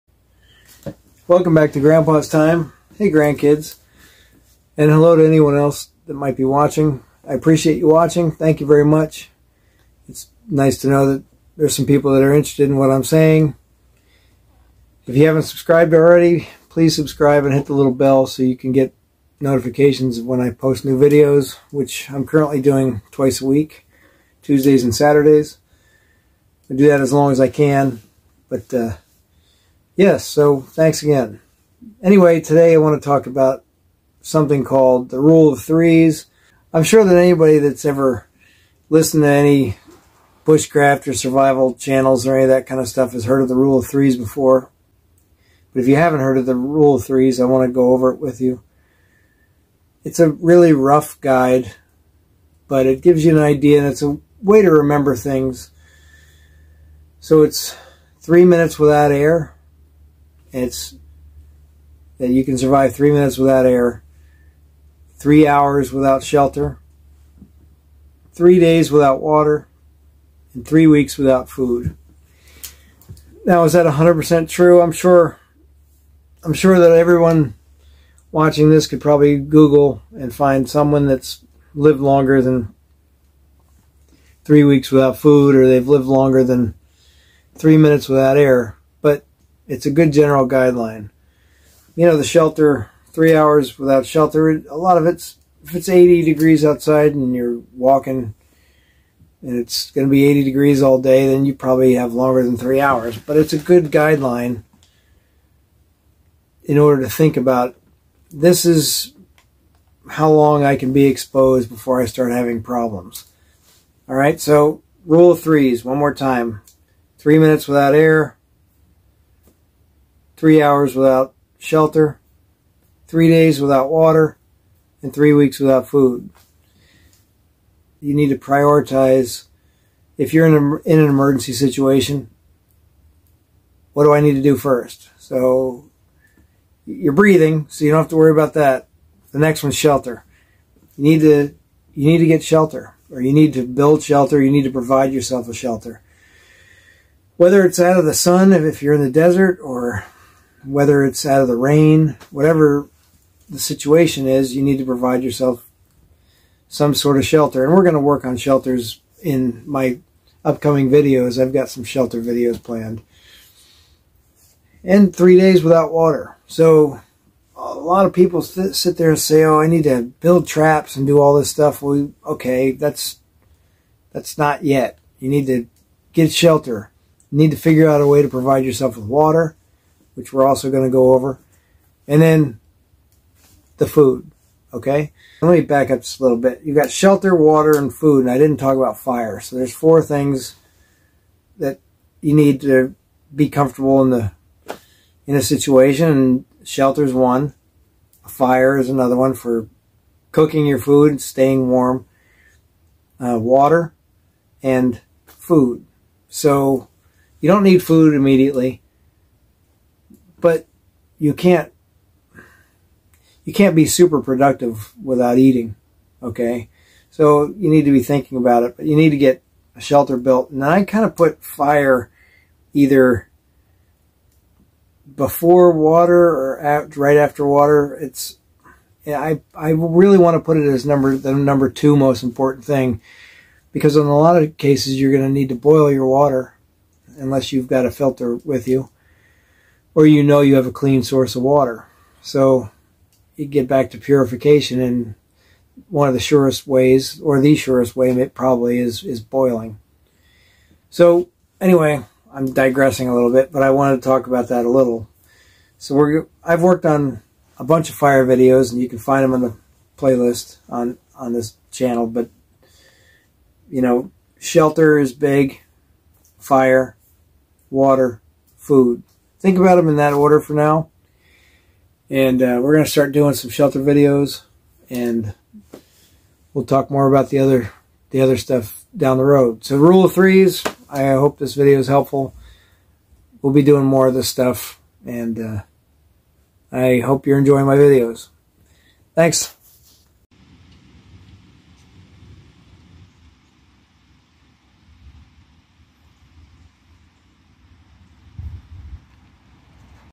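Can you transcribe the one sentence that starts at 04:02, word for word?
So you get back to purification, and one of the surest ways, or the surest way, probably is is boiling.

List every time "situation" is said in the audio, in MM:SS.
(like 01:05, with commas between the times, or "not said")
02:11, 02:33, 03:15.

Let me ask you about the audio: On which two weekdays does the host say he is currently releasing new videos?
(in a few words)
Tuesdays and Saturdays.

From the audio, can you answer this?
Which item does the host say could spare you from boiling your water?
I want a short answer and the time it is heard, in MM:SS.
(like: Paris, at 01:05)
a filter, at 03:57.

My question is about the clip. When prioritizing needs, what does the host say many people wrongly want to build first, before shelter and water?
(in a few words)
traps.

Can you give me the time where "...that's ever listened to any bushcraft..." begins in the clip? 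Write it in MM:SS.
00:37.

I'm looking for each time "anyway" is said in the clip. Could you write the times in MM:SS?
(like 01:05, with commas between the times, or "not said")
00:32, 04:11.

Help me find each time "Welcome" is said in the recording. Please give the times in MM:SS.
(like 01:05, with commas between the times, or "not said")
00:01.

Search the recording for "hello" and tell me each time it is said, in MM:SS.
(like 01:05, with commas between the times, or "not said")
00:04.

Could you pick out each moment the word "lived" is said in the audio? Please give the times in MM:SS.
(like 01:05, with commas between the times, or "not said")
01:21, 01:25.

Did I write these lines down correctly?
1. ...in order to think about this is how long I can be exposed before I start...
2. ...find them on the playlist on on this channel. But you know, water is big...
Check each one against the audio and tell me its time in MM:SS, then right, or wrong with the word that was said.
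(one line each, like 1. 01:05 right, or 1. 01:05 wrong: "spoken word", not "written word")
1. 01:46 right
2. 04:18 wrong: "shelter", not "water".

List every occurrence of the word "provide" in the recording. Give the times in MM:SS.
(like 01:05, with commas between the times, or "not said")
02:24, 02:34, 02:58.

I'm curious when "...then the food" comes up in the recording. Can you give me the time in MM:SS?
03:02.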